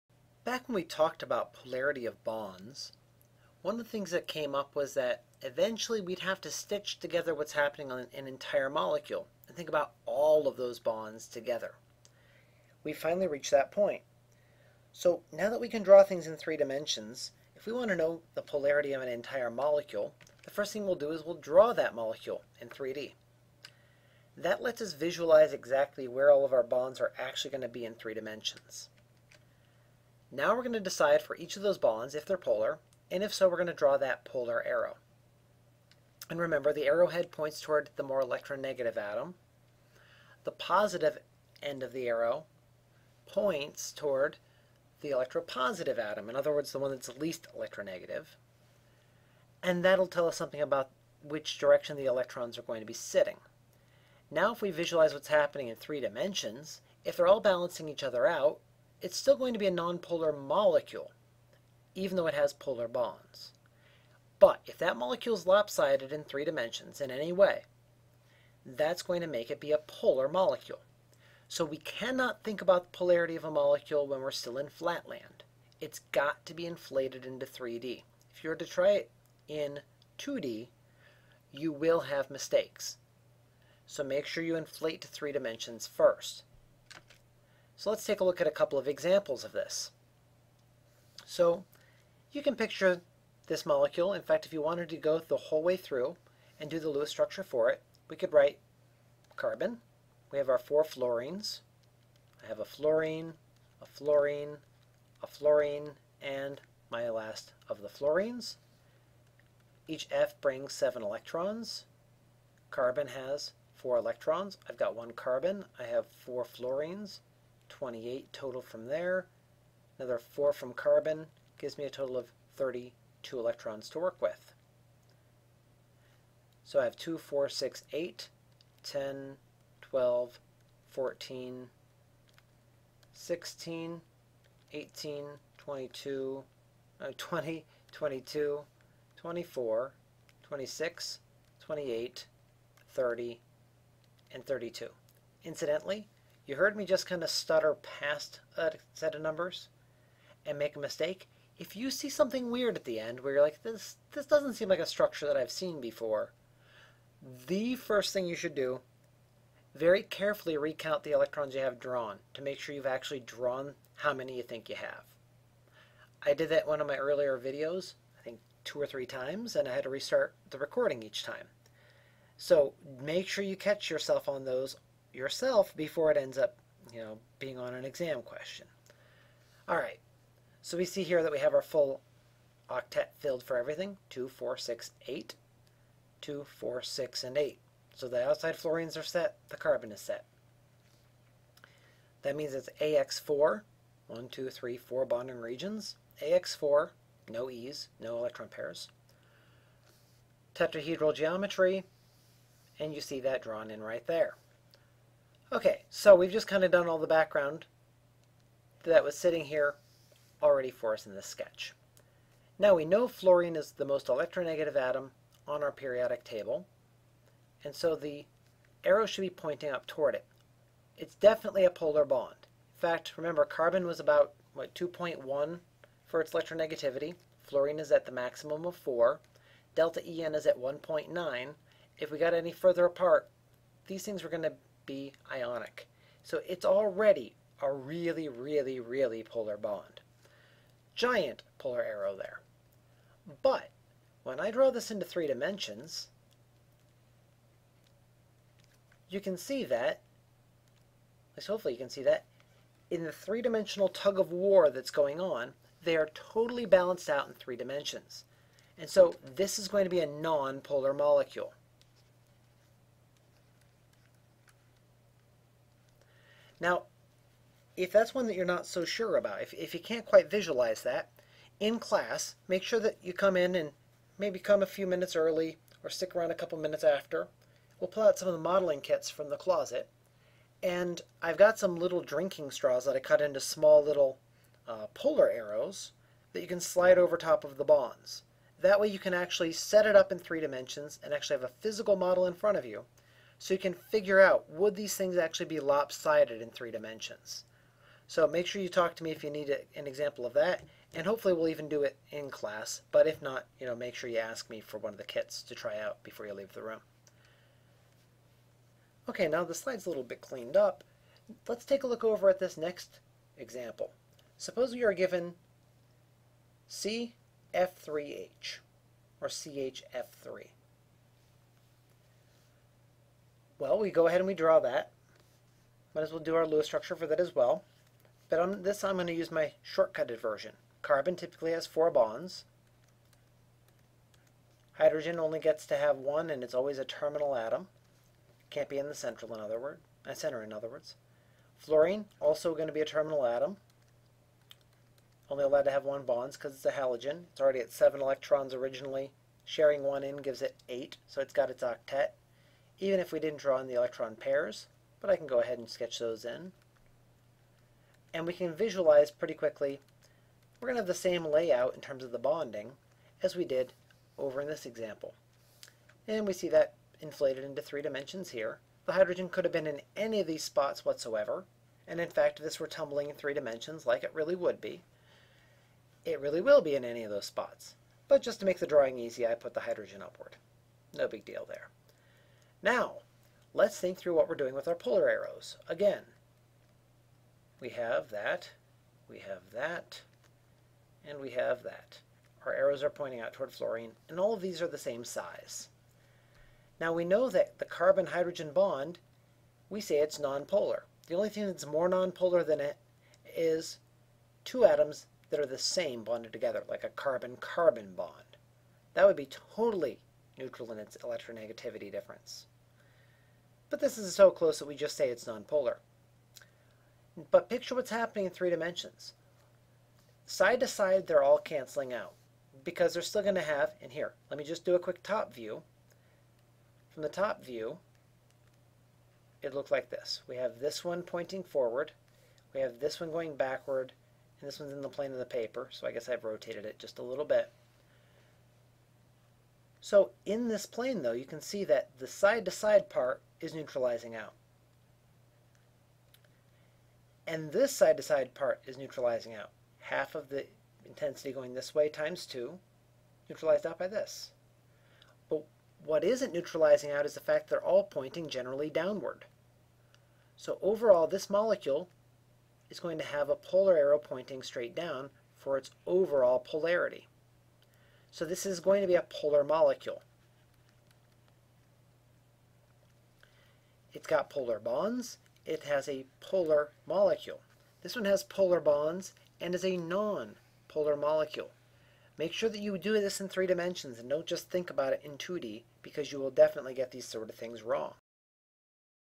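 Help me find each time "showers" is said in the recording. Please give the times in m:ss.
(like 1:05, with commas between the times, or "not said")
not said.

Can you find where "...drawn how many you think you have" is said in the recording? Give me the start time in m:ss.
2:43.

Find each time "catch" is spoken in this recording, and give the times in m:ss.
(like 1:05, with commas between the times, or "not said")
2:53.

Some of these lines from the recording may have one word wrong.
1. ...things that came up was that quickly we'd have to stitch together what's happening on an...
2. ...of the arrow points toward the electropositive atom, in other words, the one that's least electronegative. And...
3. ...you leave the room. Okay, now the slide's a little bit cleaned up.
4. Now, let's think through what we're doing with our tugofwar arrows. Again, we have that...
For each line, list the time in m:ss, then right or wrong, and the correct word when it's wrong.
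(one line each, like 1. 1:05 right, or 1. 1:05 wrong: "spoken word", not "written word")
1. 0:03 wrong: "eventually", not "quickly"
2. 0:41 right
3. 5:06 right
4. 6:22 wrong: "polar", not "tugofwar".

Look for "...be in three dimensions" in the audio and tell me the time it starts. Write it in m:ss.
0:27.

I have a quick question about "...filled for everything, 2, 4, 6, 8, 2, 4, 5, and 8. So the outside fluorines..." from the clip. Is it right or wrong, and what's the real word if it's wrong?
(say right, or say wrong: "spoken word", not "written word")
wrong: "6", not "5".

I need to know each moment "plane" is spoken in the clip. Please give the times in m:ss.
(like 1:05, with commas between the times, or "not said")
7:14, 7:20.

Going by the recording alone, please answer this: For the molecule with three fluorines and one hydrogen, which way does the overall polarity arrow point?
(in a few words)
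straight down.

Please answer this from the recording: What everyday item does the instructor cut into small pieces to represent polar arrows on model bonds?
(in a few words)
drinking straws.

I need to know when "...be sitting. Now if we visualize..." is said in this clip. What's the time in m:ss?
0:52.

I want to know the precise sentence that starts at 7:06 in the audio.
From the top view, it looked like this.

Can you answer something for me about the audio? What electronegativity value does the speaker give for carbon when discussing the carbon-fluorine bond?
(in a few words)
2.1.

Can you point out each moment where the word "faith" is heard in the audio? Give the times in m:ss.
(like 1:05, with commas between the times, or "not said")
not said.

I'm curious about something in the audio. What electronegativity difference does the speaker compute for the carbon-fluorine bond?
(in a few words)
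1.9.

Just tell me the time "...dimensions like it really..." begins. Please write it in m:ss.
6:13.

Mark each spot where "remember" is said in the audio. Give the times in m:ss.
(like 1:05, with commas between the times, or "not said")
0:36, 3:43.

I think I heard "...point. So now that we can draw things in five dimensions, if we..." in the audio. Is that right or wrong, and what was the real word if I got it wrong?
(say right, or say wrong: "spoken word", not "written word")
wrong: "three", not "five".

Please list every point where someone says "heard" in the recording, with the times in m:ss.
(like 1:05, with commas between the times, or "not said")
2:26.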